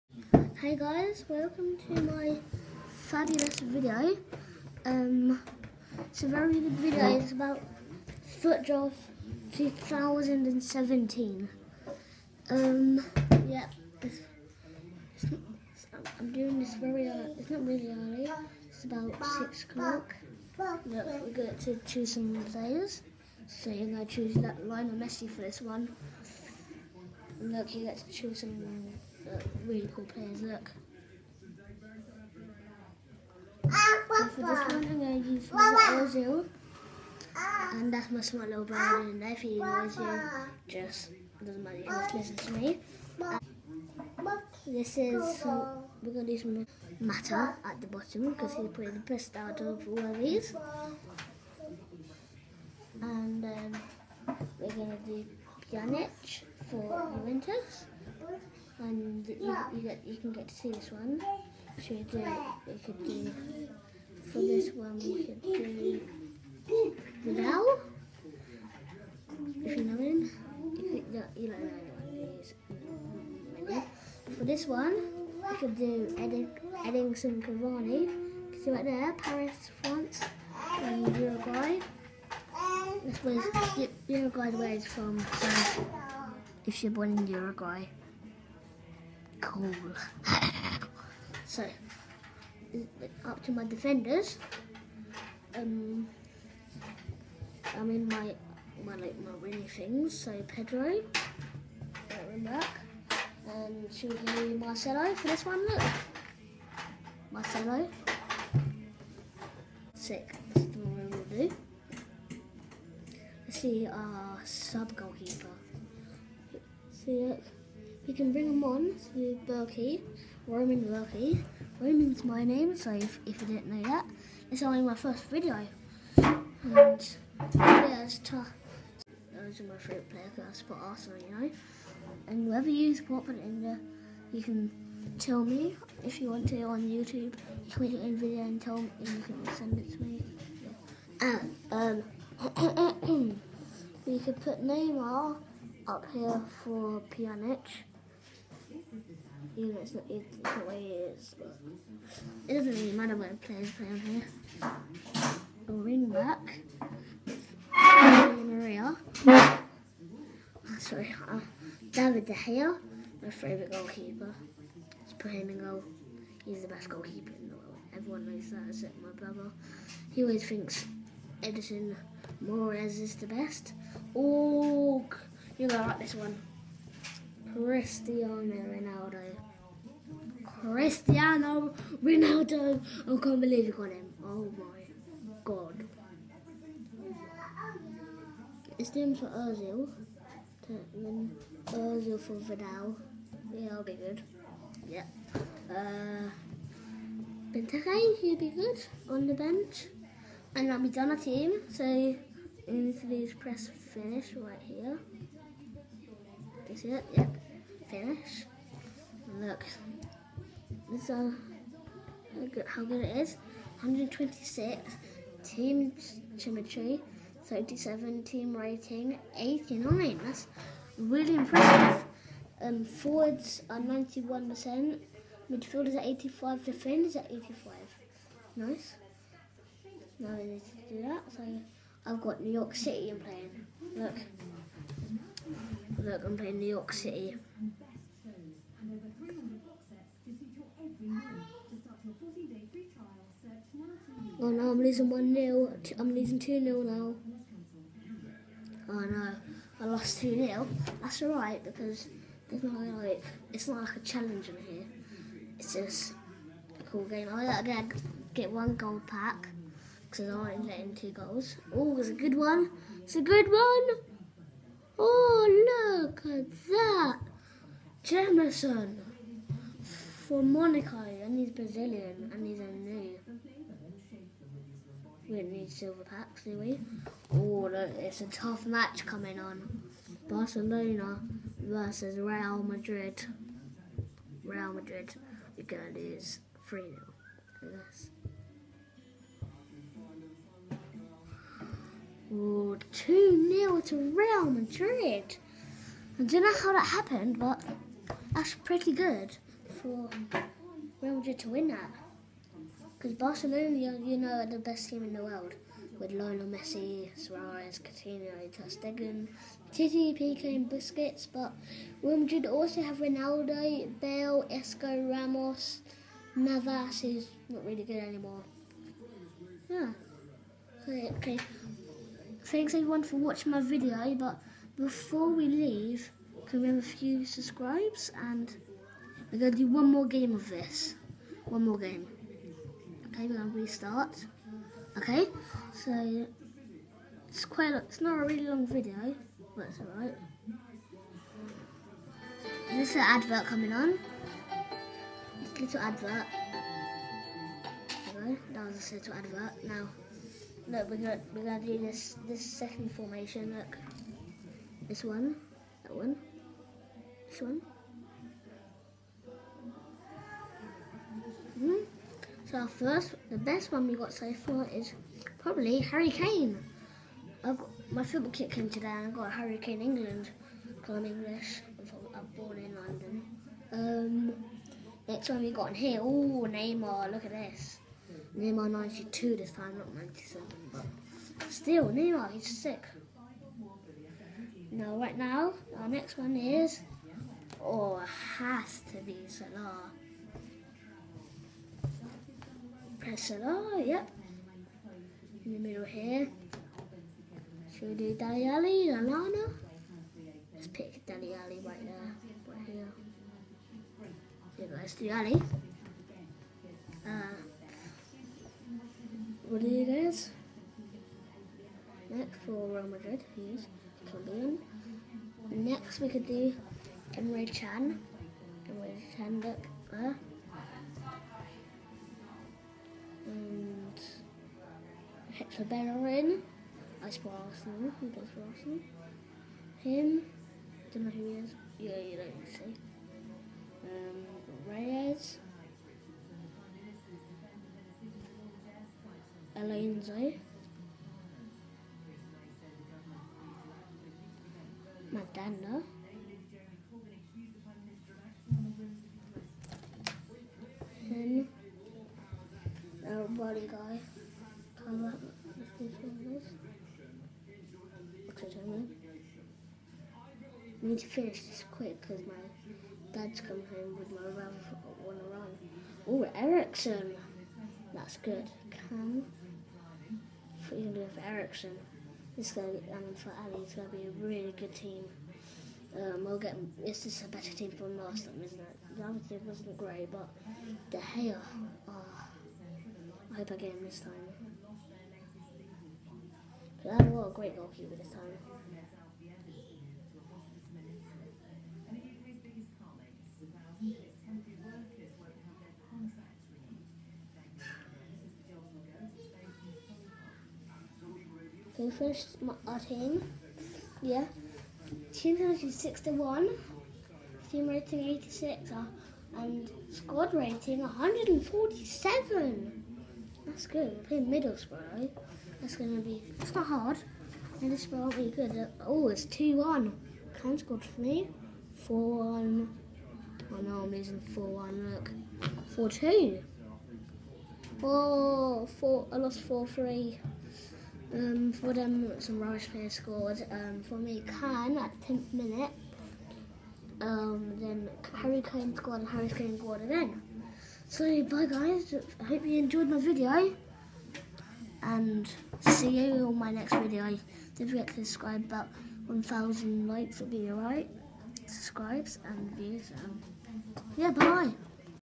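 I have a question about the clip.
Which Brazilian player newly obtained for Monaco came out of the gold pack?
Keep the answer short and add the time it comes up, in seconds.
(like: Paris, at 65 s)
Jemerson, at 268 s.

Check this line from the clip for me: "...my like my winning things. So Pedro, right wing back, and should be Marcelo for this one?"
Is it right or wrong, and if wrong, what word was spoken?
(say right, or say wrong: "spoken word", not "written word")
right.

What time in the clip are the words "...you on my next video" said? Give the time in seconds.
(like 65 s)
545 s.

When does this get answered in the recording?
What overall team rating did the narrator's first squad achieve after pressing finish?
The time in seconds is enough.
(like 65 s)
219 s.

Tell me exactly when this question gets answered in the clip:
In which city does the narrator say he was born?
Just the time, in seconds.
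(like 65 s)
372 s.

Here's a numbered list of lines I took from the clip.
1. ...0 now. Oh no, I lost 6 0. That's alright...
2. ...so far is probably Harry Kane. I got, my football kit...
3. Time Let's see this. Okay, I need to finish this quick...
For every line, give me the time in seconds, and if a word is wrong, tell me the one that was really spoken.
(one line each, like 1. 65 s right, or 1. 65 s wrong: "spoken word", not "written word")
1. 246 s wrong: "2", not "6"
2. 364 s right
3. 454 s right.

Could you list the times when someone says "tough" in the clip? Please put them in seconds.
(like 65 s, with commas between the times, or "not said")
128 s, 278 s.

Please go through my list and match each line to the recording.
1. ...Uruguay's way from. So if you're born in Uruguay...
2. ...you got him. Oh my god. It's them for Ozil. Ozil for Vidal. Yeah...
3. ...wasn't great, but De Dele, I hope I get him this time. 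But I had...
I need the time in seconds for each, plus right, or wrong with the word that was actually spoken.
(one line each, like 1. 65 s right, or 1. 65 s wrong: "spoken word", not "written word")
1. 84 s right
2. 183 s right
3. 479 s wrong: "Gea", not "Dele".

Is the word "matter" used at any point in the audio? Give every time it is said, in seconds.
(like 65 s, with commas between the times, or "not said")
41 s, 46 s, 152 s.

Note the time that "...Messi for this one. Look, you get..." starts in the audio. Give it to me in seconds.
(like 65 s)
24 s.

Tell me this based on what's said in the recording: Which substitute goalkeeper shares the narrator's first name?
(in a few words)
Roman Bürki.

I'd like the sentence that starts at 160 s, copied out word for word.
Sorry, uh, David De Gea, my favourite goalkeeper.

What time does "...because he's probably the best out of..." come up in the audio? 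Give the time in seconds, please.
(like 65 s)
48 s.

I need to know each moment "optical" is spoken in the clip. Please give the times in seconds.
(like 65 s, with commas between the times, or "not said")
not said.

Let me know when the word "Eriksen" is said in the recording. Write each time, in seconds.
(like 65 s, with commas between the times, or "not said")
466 s, 471 s.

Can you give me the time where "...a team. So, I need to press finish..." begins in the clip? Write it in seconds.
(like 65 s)
201 s.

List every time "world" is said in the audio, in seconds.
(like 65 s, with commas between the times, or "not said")
167 s, 305 s.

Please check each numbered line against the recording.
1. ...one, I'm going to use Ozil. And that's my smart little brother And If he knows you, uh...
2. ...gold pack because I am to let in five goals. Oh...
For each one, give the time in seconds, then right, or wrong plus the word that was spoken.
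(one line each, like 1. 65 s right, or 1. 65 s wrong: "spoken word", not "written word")
1. 34 s right
2. 258 s wrong: "two", not "five".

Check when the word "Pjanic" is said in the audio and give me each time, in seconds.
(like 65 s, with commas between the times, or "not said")
55 s, 147 s.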